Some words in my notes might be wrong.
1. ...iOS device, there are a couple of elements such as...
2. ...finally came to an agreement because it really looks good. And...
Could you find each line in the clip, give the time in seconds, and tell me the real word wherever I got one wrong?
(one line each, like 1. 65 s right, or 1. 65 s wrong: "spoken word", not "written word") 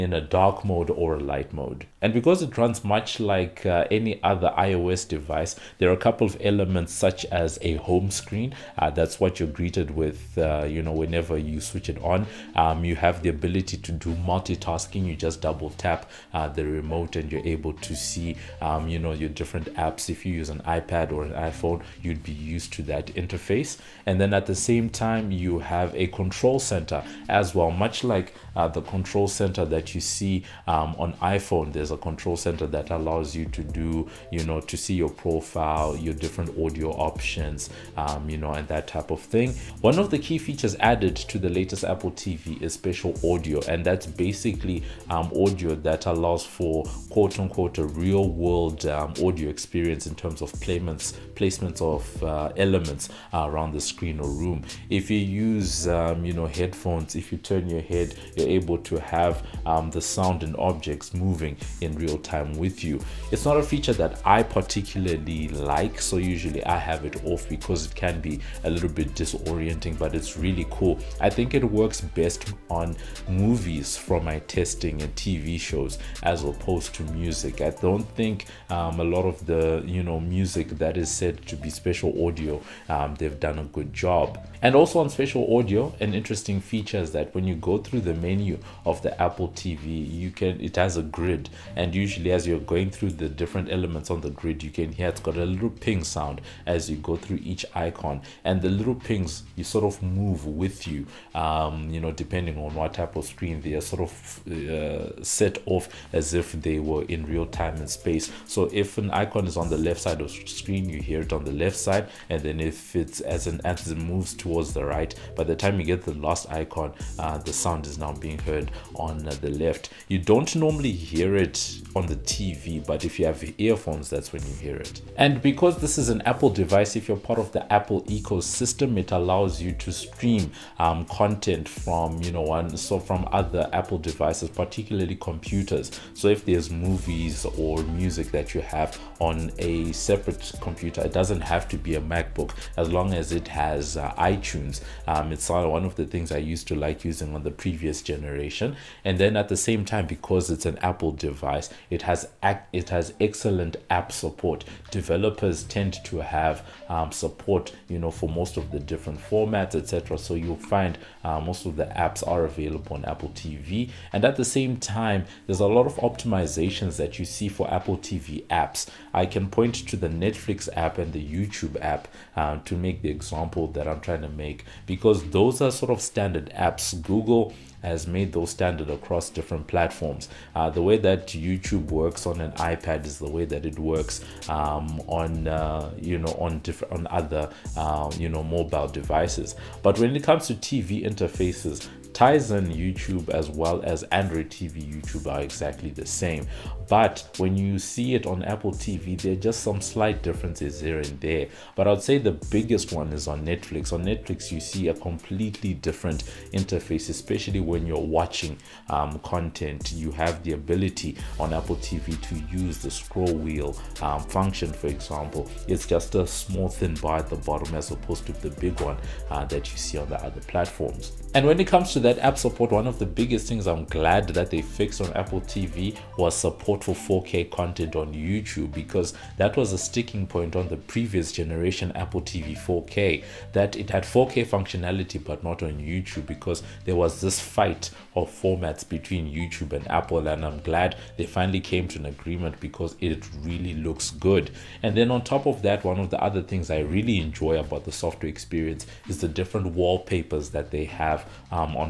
1. 4 s right
2. 241 s right.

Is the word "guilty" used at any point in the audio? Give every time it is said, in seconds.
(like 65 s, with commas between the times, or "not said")
not said.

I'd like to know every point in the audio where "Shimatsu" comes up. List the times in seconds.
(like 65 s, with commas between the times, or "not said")
not said.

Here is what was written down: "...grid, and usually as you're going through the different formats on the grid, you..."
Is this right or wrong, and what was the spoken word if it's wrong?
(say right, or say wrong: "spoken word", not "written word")
wrong: "elements", not "formats".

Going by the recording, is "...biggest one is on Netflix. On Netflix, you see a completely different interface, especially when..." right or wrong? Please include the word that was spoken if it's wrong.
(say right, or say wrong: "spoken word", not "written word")
right.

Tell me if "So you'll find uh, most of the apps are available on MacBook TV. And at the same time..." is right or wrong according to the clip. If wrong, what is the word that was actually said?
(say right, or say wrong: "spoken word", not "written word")
wrong: "Apple", not "MacBook".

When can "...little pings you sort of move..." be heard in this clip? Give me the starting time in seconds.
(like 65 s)
98 s.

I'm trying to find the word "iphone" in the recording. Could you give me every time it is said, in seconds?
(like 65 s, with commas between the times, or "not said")
21 s, 31 s.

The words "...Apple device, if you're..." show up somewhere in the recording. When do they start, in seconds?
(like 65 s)
126 s.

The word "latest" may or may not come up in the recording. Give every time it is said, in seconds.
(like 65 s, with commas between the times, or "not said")
41 s.